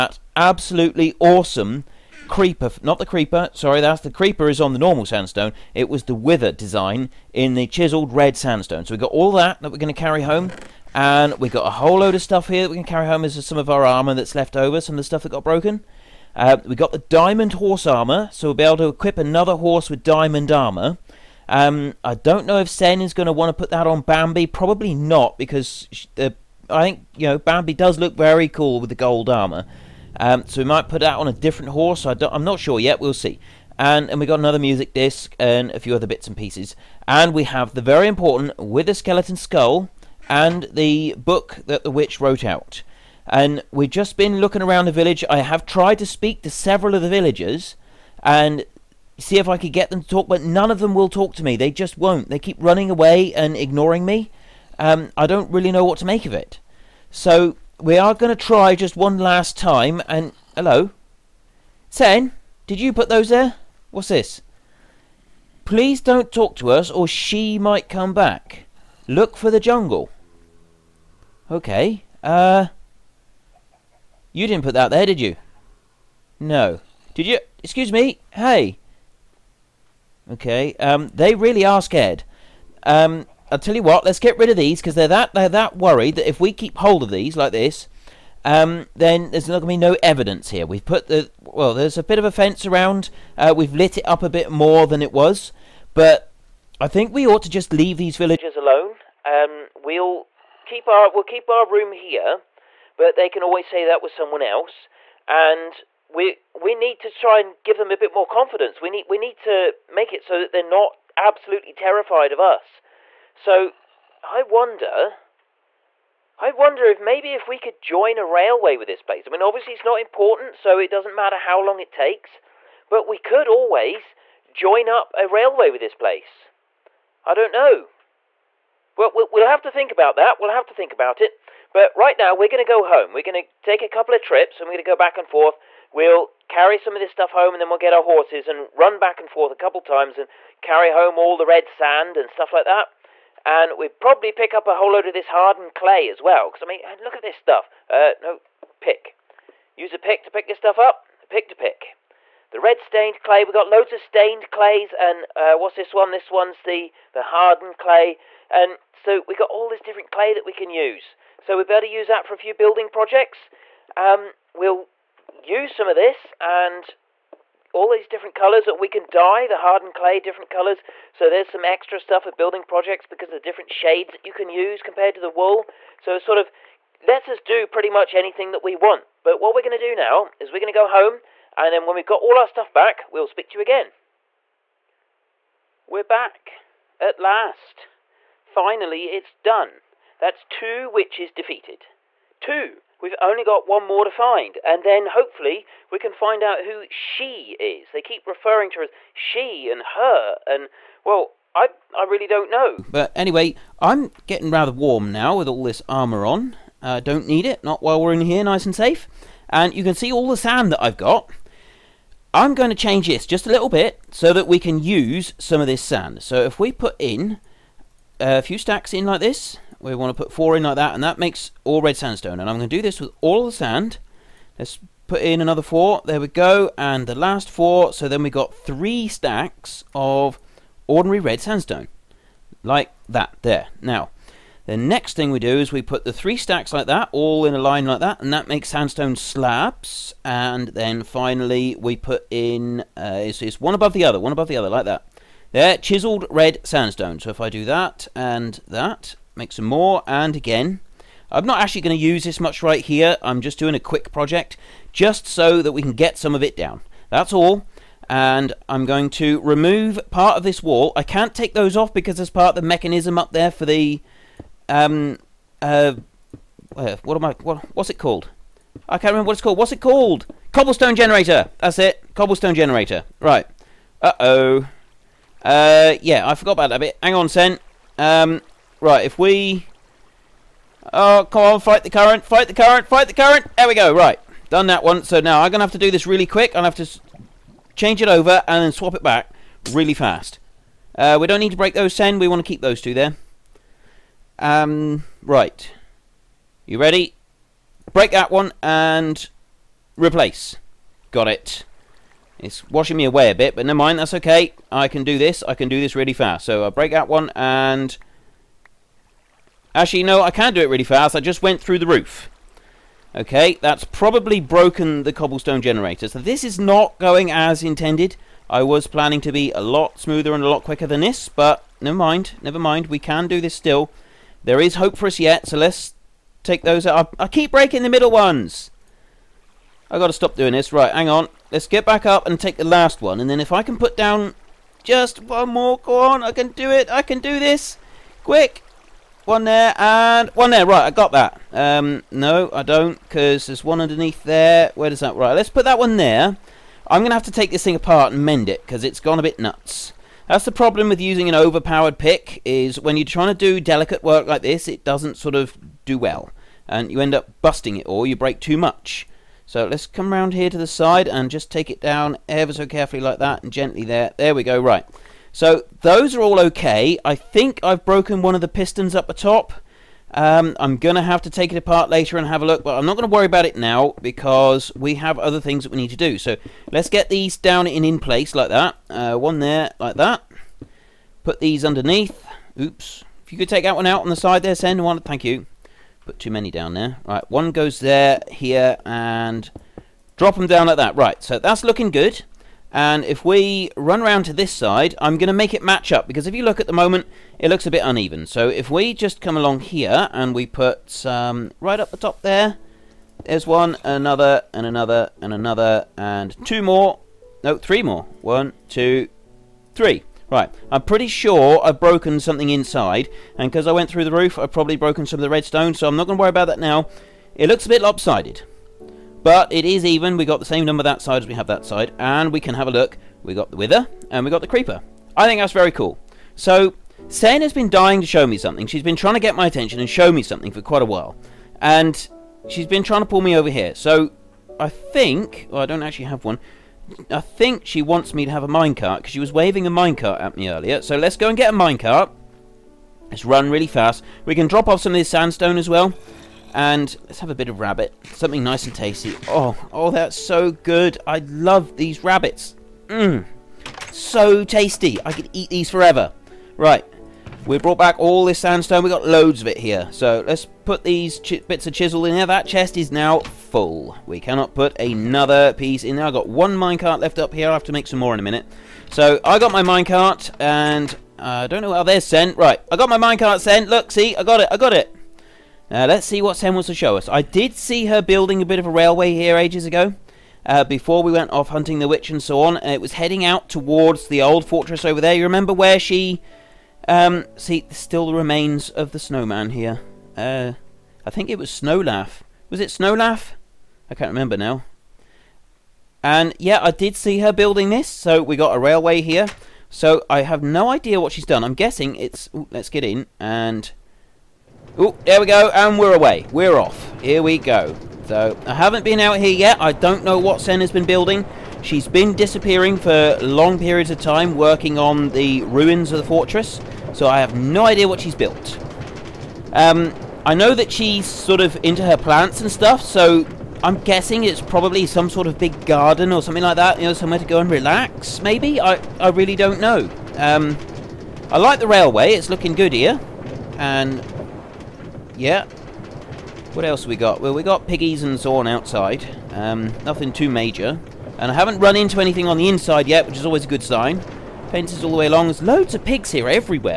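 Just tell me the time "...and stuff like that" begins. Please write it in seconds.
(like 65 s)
142 s.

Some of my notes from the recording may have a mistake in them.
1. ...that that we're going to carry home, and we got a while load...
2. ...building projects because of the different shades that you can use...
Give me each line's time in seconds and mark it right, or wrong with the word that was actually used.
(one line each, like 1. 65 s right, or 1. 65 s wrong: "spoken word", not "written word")
1. 9 s wrong: "whole", not "while"
2. 172 s right.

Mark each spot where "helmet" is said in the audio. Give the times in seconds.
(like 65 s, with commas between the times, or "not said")
not said.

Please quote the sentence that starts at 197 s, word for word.
They keep referring to her as she and her, and well, I I really don't know.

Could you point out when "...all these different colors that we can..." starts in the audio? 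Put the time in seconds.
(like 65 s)
167 s.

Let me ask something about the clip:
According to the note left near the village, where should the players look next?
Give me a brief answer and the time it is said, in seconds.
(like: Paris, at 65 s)
the jungle, at 69 s.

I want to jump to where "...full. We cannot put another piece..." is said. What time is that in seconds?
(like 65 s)
463 s.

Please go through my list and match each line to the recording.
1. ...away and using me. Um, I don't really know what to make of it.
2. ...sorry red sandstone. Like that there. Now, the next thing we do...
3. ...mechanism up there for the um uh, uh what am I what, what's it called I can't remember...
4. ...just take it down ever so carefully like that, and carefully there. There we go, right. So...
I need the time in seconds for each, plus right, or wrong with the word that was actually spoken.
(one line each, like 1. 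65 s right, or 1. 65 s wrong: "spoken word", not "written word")
1. 52 s wrong: "ignoring", not "using"
2. 230 s wrong: "ordinary", not "sorry"
3. 262 s right
4. 361 s wrong: "gently", not "carefully".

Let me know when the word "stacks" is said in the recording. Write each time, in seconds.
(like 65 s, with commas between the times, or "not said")
218 s, 229 s, 236 s.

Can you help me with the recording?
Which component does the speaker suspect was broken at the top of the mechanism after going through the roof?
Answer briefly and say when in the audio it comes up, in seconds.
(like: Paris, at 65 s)
pistons, at 368 s.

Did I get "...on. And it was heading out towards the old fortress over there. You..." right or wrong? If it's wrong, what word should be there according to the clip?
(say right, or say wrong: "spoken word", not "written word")
right.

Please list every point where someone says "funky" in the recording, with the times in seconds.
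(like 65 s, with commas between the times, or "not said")
not said.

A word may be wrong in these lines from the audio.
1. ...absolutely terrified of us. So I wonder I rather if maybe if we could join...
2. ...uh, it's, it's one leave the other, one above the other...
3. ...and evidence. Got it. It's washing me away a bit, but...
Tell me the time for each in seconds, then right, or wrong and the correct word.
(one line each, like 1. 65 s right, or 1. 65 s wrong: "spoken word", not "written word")
1. 111 s wrong: "wonder", not "rather"
2. 242 s wrong: "above", not "leave"
3. 298 s wrong: "replace", not "evidence".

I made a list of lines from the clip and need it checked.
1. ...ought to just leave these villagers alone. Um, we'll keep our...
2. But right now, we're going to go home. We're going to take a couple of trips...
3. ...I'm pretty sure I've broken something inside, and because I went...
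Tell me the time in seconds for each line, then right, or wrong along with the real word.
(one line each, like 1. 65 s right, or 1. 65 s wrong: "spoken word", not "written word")
1. 97 s right
2. 131 s right
3. 410 s right.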